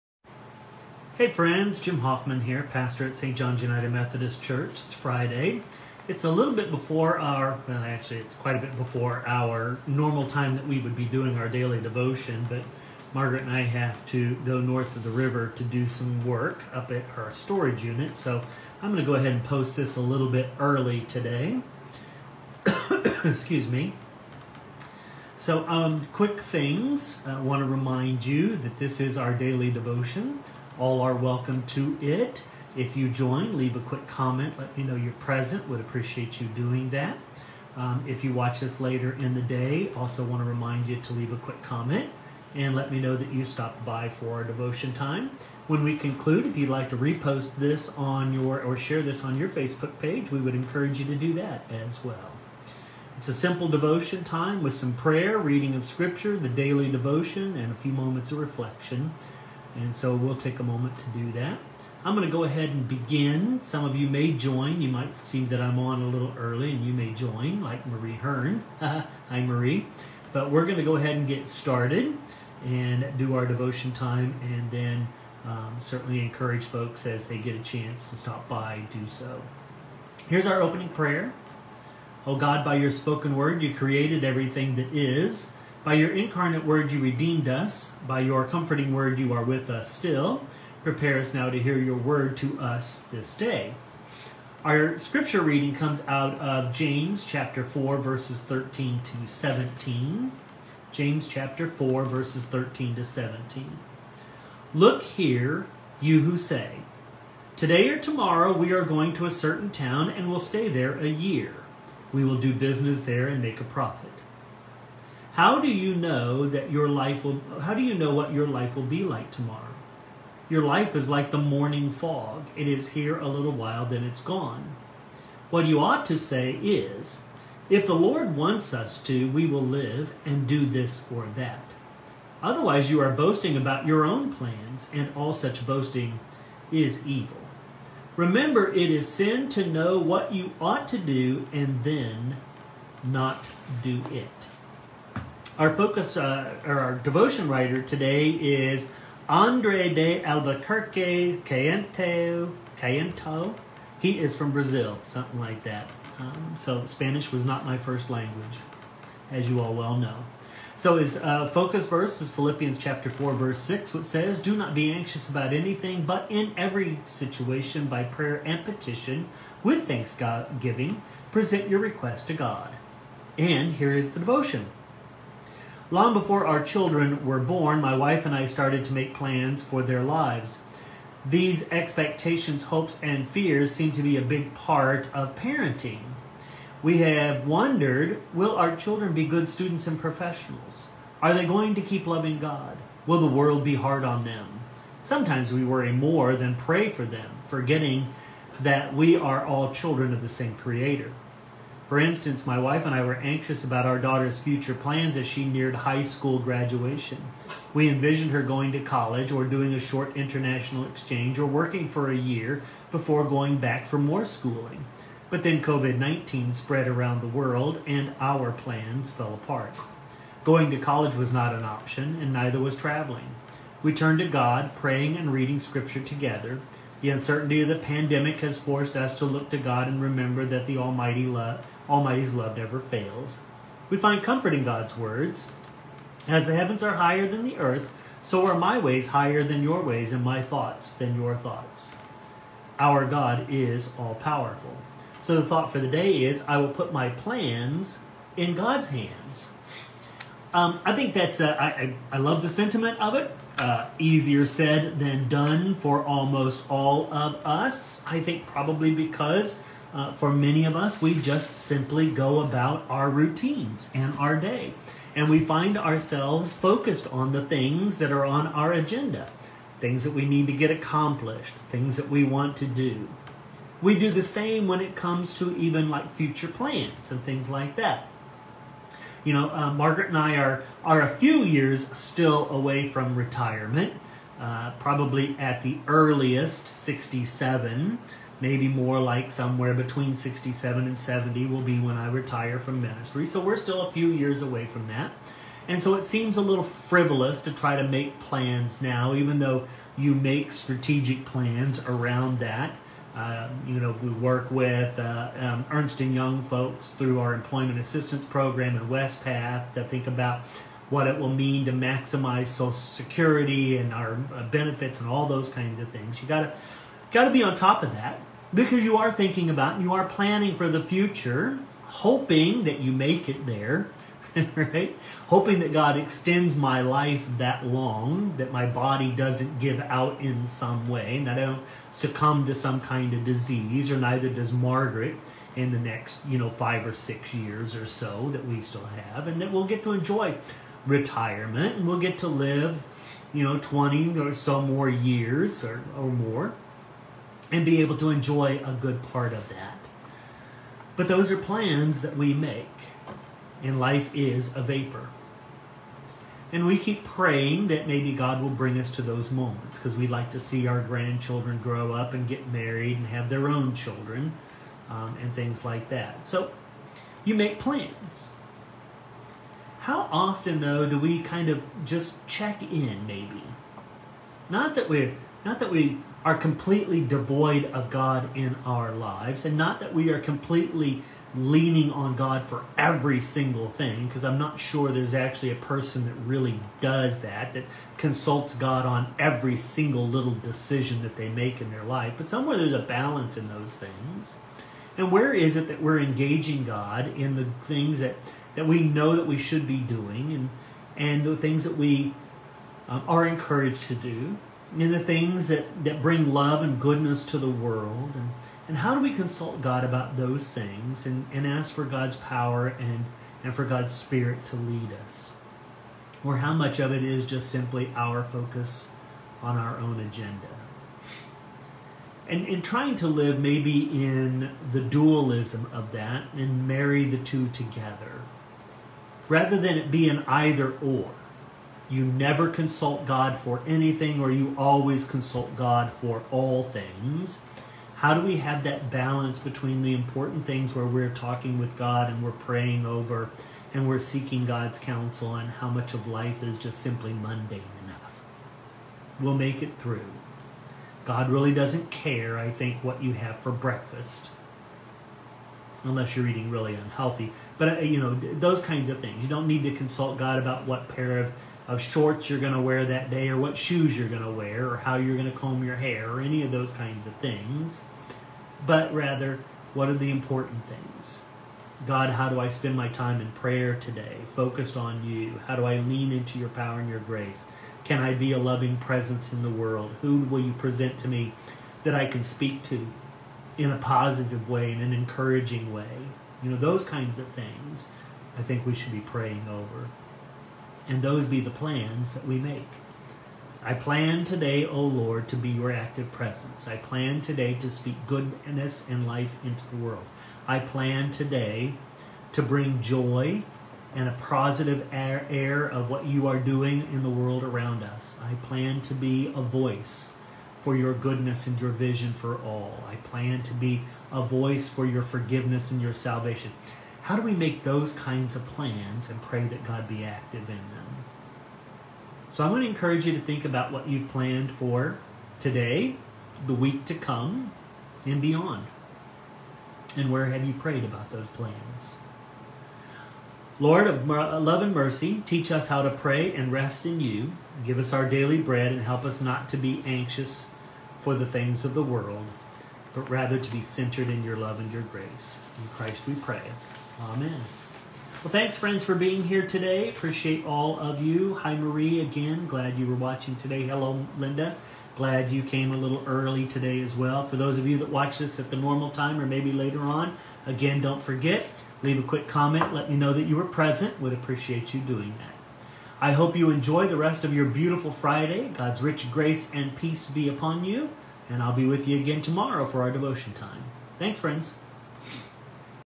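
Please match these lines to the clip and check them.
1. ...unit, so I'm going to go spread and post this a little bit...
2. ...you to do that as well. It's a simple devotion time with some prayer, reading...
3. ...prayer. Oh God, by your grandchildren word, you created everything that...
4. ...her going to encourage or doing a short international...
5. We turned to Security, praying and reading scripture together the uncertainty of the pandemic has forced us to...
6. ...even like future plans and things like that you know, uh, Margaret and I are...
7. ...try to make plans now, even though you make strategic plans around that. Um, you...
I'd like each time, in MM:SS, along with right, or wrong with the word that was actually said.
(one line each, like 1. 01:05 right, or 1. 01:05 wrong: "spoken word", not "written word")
1. 00:17 wrong: "ahead", not "spread"
2. 00:50 right
3. 01:20 wrong: "spoken", not "grandchildren"
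4. 03:28 wrong: "college", not "encourage"
5. 03:43 wrong: "God", not "Security"
6. 04:35 right
7. 04:57 right.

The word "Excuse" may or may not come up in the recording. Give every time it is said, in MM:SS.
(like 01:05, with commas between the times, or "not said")
00:23.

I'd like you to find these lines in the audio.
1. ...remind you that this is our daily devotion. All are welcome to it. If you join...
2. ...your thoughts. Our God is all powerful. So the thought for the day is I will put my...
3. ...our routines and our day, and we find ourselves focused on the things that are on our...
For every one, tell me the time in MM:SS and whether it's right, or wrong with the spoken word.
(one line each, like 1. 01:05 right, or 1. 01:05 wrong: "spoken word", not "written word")
1. 00:27 right
2. 04:01 right
3. 04:22 right.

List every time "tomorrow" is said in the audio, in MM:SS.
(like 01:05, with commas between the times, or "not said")
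01:47, 01:59, 09:32.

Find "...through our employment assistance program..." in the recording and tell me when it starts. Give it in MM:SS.
05:06.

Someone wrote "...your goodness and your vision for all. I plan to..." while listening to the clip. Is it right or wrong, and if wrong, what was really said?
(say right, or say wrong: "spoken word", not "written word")
right.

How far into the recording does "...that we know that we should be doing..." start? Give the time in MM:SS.
06:38.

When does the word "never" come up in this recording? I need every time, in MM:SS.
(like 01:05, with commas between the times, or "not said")
03:52, 07:12.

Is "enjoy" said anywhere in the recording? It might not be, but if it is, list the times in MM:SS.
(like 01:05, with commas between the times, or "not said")
05:39, 05:48, 09:26.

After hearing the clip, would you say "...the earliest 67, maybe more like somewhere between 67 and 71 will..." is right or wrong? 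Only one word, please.
wrong.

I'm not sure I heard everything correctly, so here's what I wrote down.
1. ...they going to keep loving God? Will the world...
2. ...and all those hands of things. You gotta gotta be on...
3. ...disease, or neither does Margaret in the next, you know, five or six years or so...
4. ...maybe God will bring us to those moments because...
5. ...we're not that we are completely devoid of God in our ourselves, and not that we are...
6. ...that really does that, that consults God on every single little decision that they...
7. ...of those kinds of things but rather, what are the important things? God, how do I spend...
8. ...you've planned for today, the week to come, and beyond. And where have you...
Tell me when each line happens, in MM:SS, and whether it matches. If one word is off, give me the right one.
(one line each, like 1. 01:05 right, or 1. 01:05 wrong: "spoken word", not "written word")
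1. 03:11 right
2. 05:15 wrong: "kinds", not "hands"
3. 05:33 right
4. 05:57 right
5. 06:14 wrong: "lives", not "ourselves"
6. 06:26 right
7. 07:46 right
8. 08:43 right.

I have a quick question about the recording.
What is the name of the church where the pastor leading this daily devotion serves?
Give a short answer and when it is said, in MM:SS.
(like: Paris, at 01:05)
St. John's United Methodist Church, at 00:03.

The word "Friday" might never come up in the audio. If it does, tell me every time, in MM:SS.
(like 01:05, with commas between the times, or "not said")
00:04, 09:27.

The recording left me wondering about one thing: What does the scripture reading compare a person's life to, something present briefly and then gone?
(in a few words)
Morning fog.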